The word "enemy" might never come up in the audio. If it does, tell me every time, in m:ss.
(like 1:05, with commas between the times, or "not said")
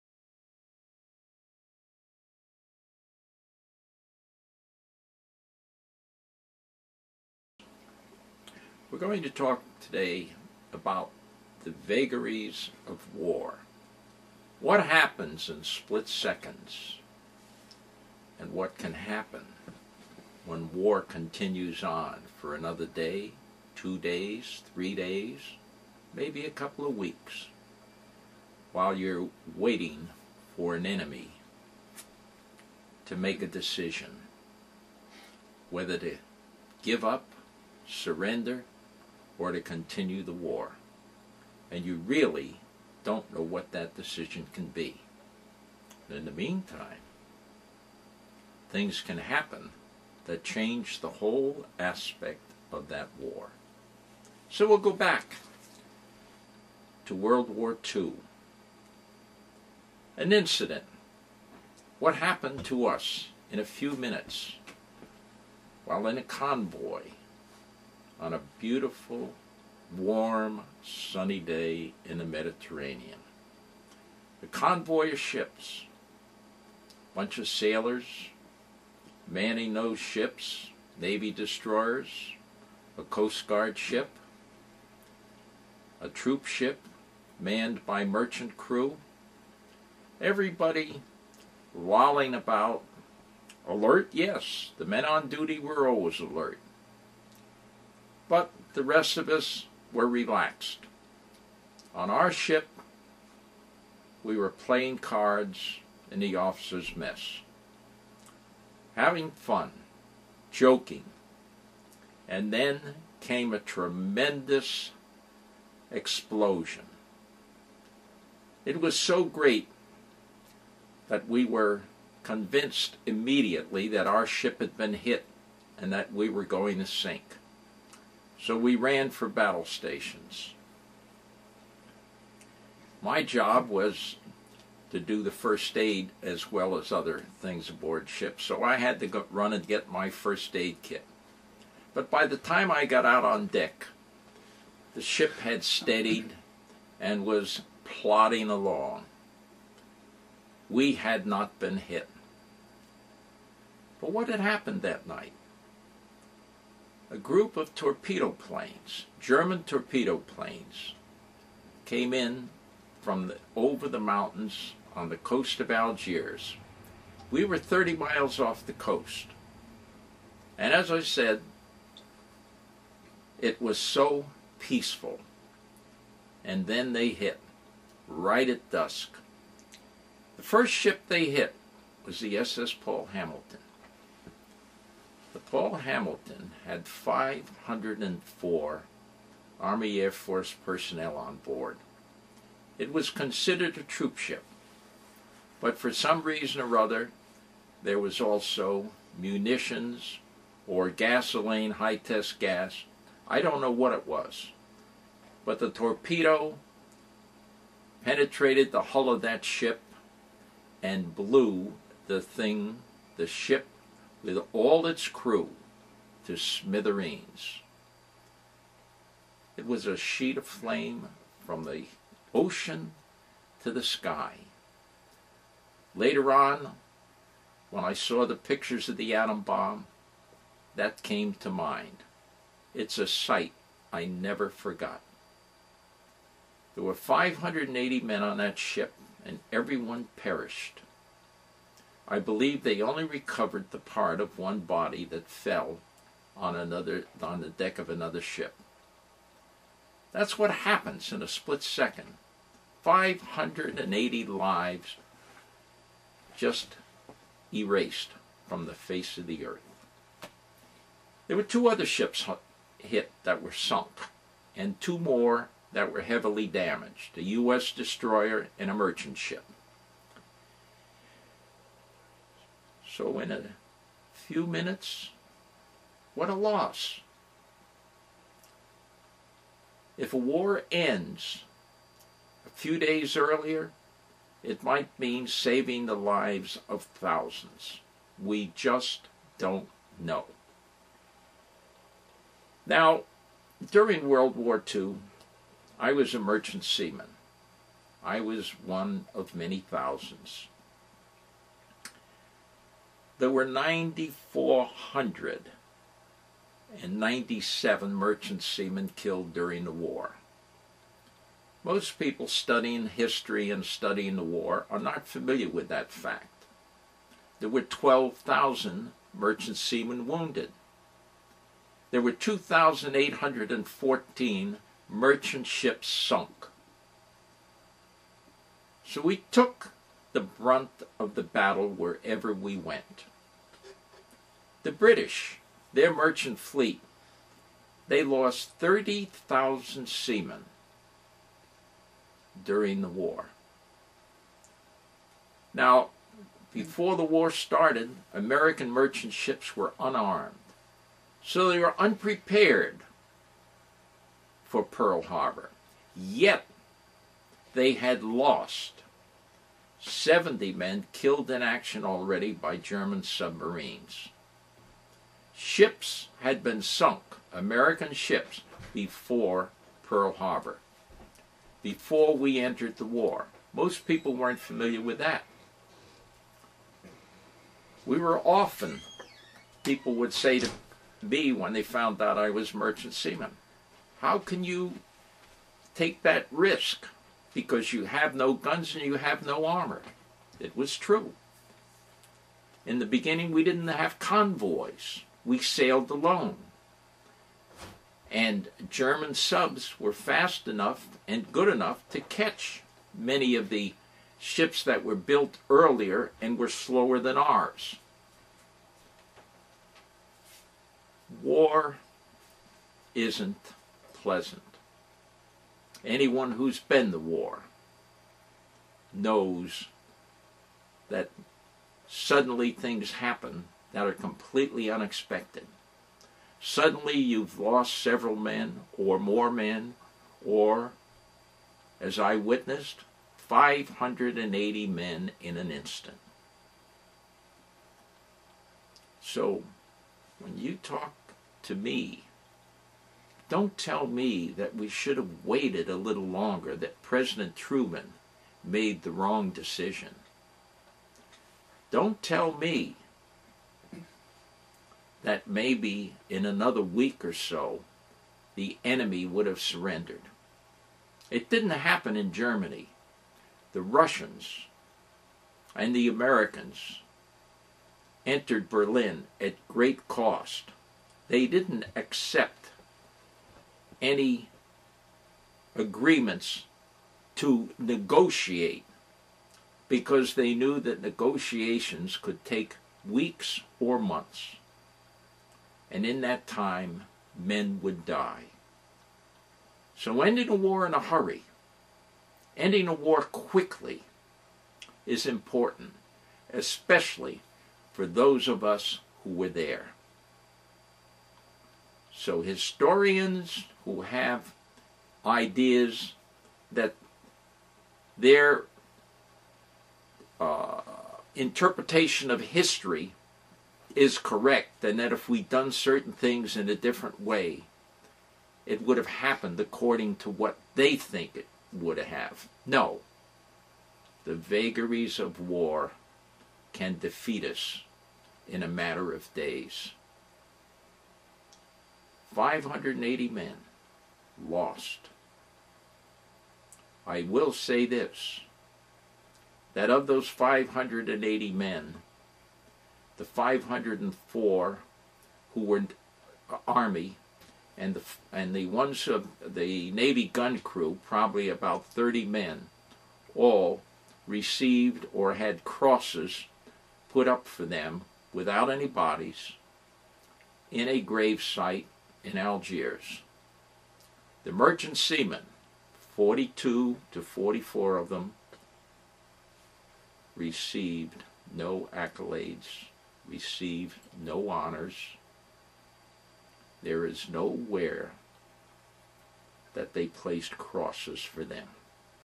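0:30, 7:38.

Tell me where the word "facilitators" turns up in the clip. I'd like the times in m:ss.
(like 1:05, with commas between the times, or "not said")
not said.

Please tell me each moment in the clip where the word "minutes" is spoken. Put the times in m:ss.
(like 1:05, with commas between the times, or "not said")
1:03, 4:34.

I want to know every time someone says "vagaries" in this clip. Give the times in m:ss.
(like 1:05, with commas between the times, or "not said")
0:11, 8:44.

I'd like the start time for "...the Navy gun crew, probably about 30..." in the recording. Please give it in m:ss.
9:09.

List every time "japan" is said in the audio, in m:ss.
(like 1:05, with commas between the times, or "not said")
not said.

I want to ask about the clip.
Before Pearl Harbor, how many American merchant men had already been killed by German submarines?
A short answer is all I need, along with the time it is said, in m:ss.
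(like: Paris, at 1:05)
70, at 5:59.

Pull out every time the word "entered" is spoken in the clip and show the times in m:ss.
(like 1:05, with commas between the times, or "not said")
6:12, 7:48.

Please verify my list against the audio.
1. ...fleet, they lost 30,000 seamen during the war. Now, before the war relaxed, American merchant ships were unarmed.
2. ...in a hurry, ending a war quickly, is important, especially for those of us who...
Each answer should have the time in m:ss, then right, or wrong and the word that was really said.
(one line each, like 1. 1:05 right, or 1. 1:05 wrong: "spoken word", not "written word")
1. 5:36 wrong: "started", not "relaxed"
2. 8:10 right.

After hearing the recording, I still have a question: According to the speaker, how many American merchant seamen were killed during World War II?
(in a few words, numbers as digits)
9,497.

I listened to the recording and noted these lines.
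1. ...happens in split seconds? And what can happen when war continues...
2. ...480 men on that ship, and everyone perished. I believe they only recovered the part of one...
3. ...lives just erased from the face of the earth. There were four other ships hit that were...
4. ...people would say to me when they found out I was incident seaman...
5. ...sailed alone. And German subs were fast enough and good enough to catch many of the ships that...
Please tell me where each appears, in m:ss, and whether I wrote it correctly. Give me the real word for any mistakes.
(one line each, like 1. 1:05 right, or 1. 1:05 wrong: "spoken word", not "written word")
1. 0:14 right
2. 3:56 wrong: "580", not "480"
3. 4:14 wrong: "two", not "four"
4. 6:19 wrong: "merchant", not "incident"
5. 6:35 right.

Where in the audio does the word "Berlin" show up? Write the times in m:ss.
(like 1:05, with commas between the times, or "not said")
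7:48.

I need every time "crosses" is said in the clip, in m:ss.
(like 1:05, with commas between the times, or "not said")
9:15, 9:40.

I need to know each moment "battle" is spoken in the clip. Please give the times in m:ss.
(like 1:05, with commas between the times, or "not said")
2:09, 5:31.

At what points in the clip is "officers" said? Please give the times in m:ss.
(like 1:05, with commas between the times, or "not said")
1:46.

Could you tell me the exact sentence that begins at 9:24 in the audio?
The merchant seamen, 42 to 44 of them, received no accolades receive no honors.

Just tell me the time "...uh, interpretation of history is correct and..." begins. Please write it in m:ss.
8:30.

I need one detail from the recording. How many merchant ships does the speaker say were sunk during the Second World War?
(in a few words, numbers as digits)
2,814.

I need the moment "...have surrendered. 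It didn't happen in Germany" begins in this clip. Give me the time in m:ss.
7:39.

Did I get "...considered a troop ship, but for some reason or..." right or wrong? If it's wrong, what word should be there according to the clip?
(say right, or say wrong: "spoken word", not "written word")
right.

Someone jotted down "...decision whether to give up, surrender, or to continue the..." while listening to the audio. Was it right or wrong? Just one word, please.
right.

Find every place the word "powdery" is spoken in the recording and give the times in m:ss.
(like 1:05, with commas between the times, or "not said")
not said.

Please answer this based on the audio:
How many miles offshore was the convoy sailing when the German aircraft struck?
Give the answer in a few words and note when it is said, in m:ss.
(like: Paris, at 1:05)
30, at 2:47.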